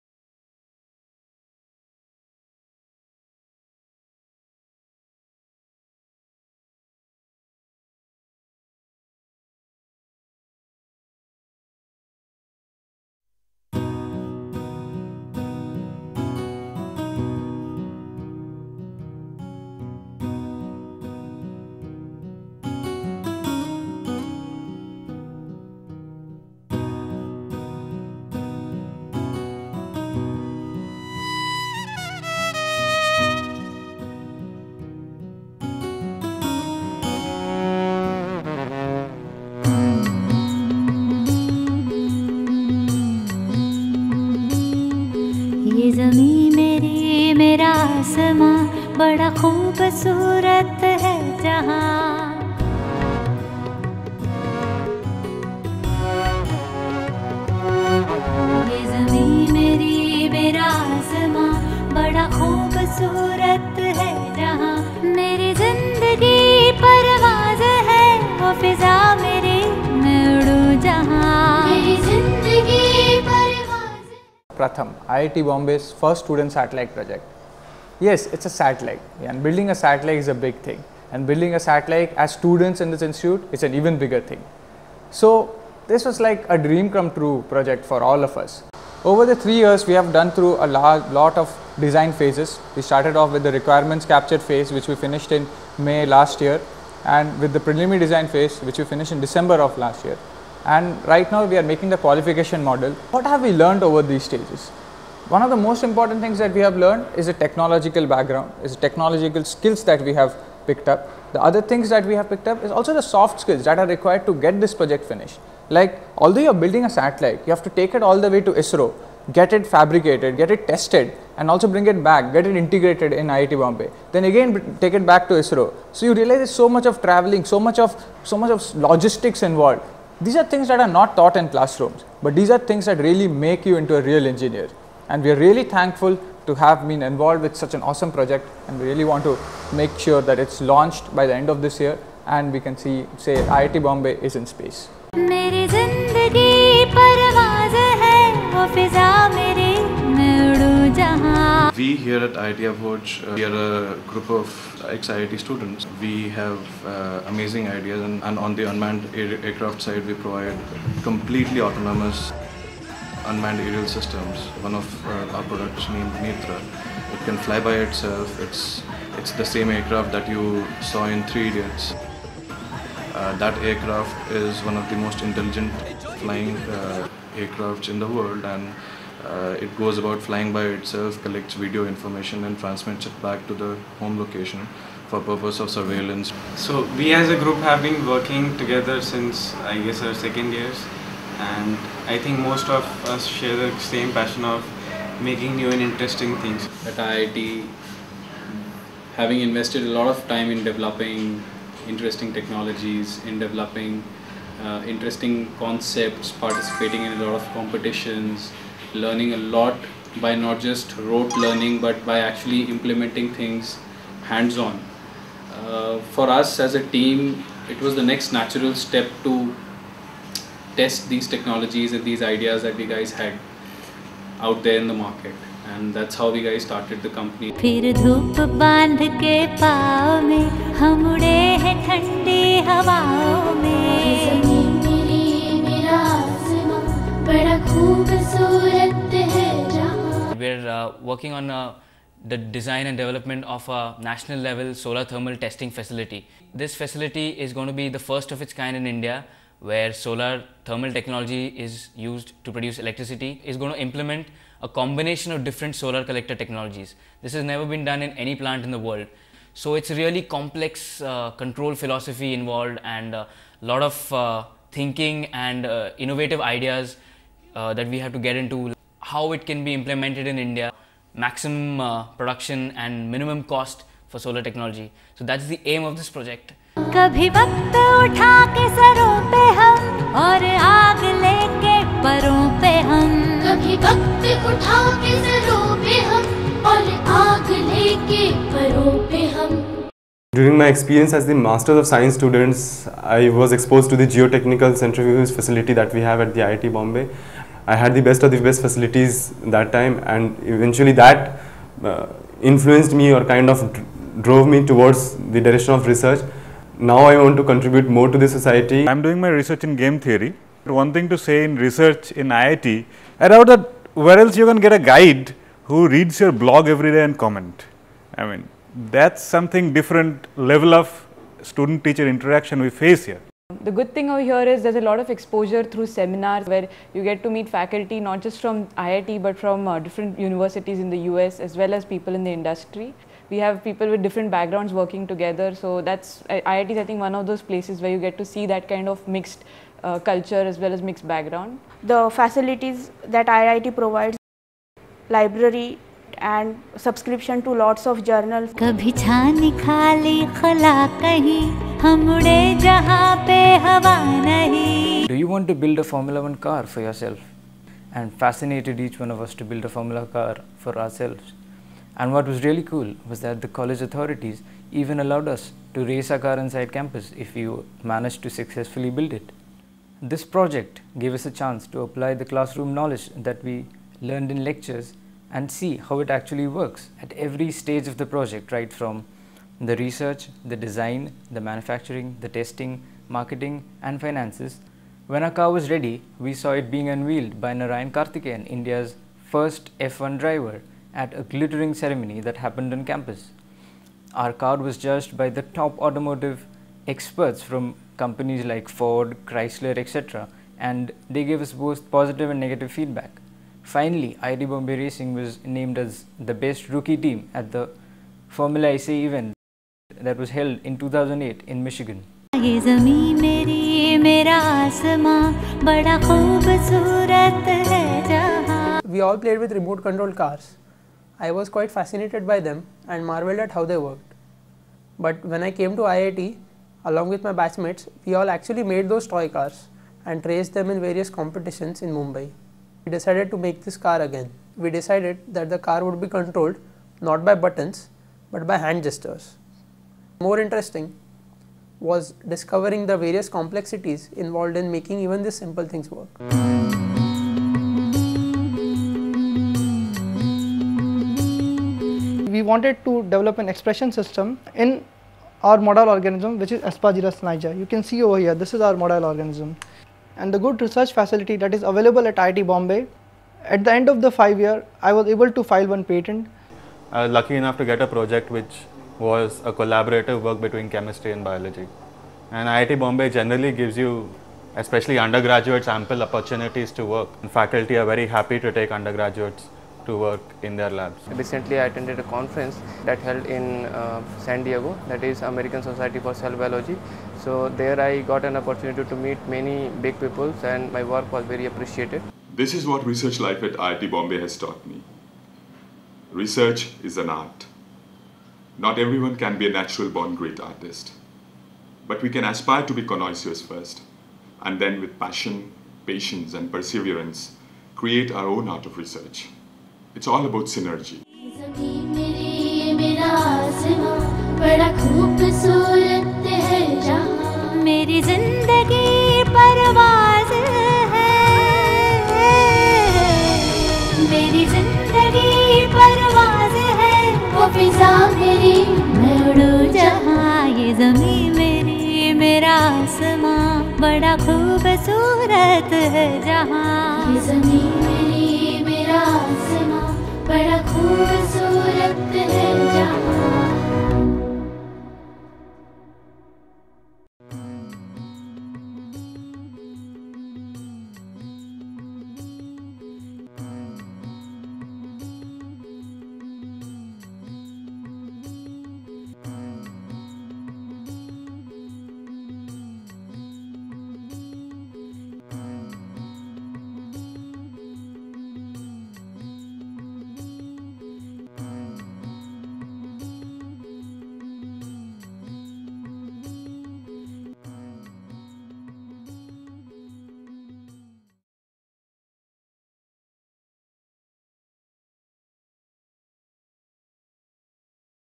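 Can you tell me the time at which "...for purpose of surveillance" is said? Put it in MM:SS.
03:05.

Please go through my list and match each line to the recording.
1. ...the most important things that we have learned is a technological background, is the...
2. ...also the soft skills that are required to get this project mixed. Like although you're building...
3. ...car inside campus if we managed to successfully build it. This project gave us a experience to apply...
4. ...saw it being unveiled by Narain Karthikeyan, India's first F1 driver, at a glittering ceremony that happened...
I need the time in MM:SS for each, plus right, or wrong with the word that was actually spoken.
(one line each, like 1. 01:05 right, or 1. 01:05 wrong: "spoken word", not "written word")
1. 01:45 right
2. 01:52 wrong: "finished", not "mixed"
3. 06:06 wrong: "chance", not "experience"
4. 06:26 right.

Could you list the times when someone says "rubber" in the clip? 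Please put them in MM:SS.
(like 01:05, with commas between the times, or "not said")
not said.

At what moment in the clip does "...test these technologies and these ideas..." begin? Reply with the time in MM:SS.
03:40.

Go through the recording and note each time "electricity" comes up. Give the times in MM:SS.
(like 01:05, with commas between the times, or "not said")
04:12.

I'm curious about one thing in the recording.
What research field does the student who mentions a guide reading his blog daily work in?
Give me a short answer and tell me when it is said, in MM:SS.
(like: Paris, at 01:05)
game theory, at 05:09.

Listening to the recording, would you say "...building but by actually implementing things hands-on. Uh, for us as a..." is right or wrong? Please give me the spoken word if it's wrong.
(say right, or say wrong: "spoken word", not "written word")
wrong: "learning", not "building".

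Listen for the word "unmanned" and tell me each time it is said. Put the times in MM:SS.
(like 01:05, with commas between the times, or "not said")
02:38, 02:43.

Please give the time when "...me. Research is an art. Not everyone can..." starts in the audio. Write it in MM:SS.
08:14.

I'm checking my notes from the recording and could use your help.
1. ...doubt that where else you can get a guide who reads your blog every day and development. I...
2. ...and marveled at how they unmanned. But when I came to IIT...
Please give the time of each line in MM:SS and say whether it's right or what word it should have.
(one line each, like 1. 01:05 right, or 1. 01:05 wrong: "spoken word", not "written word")
1. 05:13 wrong: "comment", not "development"
2. 07:02 wrong: "worked", not "unmanned".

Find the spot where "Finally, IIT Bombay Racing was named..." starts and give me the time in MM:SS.
06:43.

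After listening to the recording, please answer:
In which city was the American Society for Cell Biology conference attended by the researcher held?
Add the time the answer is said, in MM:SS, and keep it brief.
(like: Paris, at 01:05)
San Diego, at 08:04.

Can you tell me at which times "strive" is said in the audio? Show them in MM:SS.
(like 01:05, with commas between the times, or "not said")
not said.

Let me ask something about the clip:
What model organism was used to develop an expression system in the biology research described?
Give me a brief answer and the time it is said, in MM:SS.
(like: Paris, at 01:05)
Aspergillus niger, at 07:36.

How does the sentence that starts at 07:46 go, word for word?
I was lucky enough to get a project which was a collaborative work between chemistry and biology.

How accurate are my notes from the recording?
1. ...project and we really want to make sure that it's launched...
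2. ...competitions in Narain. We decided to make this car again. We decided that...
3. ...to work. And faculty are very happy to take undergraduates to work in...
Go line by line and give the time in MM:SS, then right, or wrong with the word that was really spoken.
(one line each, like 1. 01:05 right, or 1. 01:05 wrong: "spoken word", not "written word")
1. 02:18 right
2. 07:11 wrong: "Mumbai", not "Narain"
3. 07:56 right.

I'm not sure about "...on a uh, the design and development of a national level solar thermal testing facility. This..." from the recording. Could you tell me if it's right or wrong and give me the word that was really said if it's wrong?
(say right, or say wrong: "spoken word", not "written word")
right.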